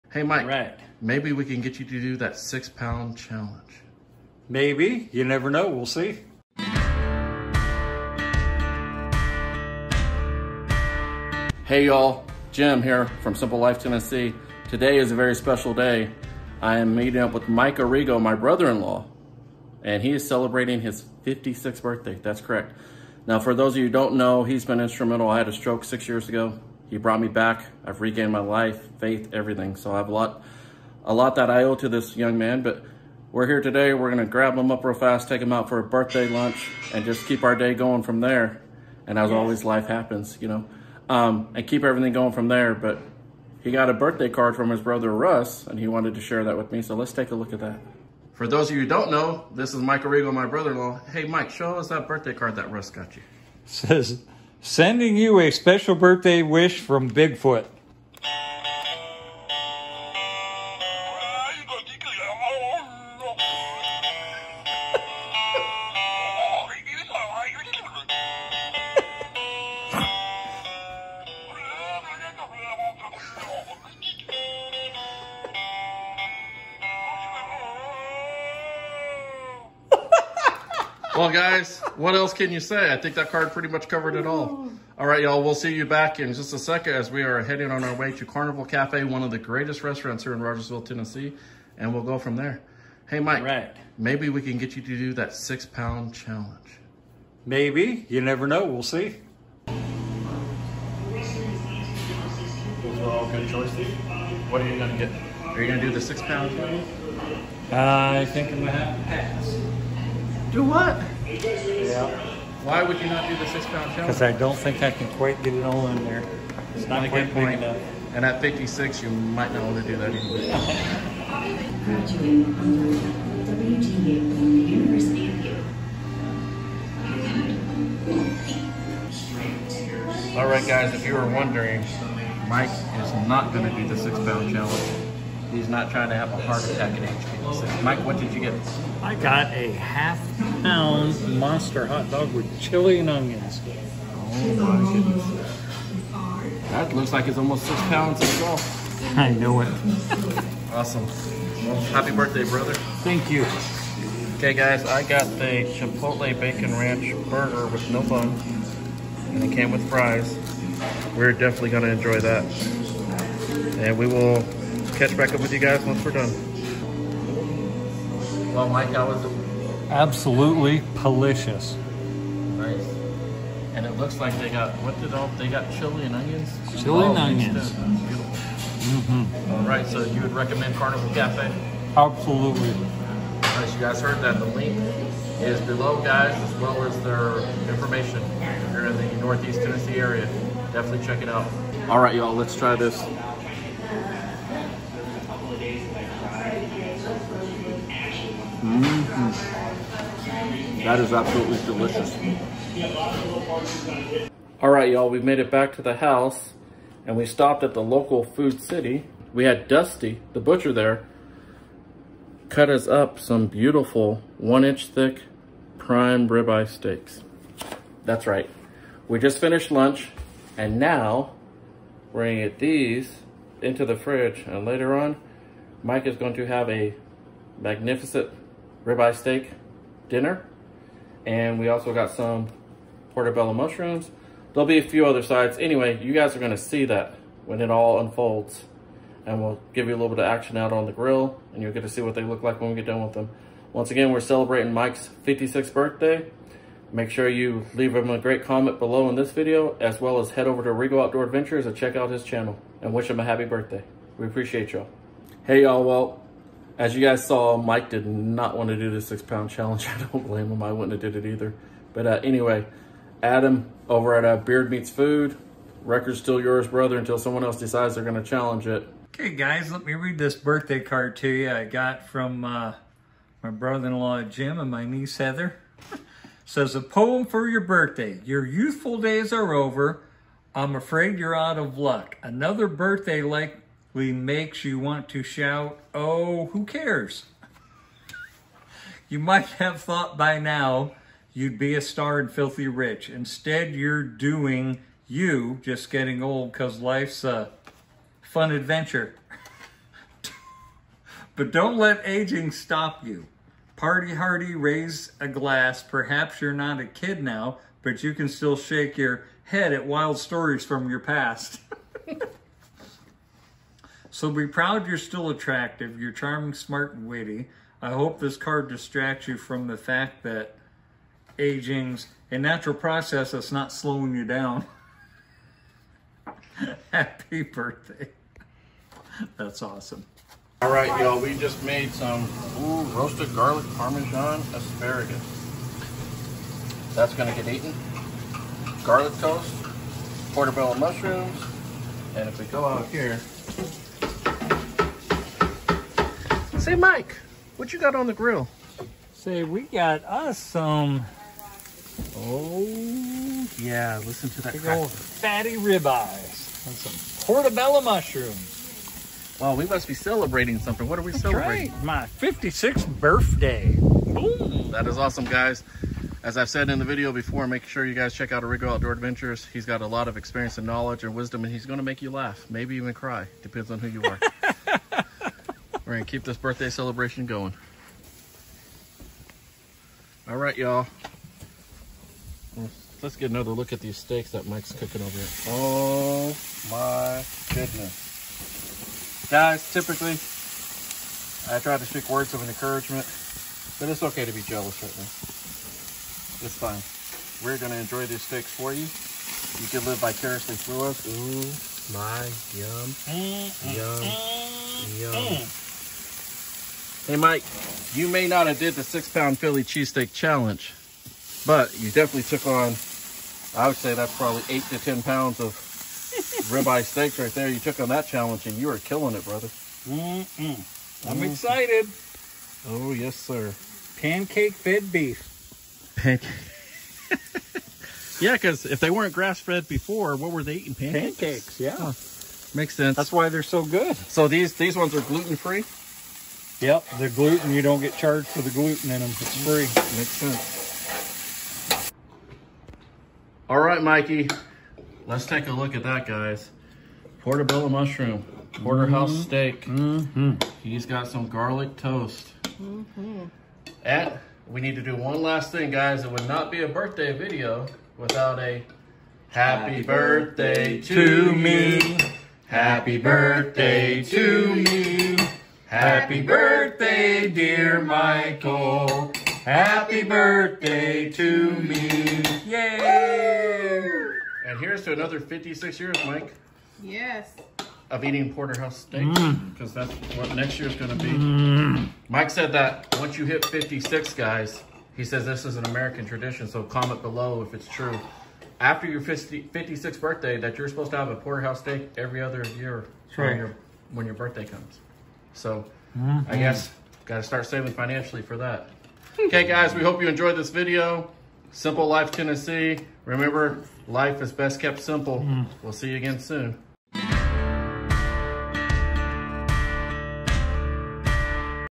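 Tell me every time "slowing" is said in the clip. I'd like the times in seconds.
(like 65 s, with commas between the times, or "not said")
323 s.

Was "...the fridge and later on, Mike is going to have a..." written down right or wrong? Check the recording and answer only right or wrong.
right.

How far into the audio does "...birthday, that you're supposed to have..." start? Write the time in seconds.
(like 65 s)
490 s.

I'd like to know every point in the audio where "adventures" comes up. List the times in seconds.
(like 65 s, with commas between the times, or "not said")
251 s, 298 s, 368 s.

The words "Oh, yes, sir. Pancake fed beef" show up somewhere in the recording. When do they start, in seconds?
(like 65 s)
422 s.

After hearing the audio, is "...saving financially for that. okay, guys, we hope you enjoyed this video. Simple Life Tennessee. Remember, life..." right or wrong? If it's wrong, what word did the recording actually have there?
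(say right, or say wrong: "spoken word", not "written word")
right.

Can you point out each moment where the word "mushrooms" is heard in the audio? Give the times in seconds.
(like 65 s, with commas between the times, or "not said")
233 s, 340 s, 357 s, 447 s.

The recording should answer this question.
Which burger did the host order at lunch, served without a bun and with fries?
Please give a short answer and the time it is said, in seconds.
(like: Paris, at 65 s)
Chipotle Bacon Ranch burger, at 155 s.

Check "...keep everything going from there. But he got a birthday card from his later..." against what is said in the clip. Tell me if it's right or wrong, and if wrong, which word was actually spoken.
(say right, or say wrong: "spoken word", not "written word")
wrong: "brother", not "later".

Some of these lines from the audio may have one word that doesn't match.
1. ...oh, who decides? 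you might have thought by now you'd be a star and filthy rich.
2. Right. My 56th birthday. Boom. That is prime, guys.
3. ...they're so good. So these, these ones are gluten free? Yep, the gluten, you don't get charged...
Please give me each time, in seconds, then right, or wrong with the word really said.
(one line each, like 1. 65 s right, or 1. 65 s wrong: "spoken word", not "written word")
1. 285 s wrong: "cares", not "decides"
2. 361 s wrong: "awesome", not "prime"
3. 433 s right.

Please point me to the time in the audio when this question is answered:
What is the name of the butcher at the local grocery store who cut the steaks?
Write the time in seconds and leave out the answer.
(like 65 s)
209 s.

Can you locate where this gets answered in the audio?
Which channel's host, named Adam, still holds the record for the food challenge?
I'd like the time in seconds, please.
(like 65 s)
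264 s.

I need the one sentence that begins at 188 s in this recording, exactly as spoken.
If you're in the Northeast Tennessee area, definitely check it out.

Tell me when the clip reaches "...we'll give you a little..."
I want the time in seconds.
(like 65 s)
239 s.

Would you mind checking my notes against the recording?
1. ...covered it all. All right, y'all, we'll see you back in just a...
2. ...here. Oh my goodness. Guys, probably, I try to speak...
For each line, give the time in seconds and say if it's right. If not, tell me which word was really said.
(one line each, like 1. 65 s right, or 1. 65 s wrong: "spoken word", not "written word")
1. 83 s right
2. 385 s wrong: "typically", not "probably".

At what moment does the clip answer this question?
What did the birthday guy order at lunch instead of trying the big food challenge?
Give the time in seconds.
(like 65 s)
139 s.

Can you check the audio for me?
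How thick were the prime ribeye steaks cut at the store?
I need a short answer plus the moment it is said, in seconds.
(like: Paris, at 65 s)
1 inch, at 214 s.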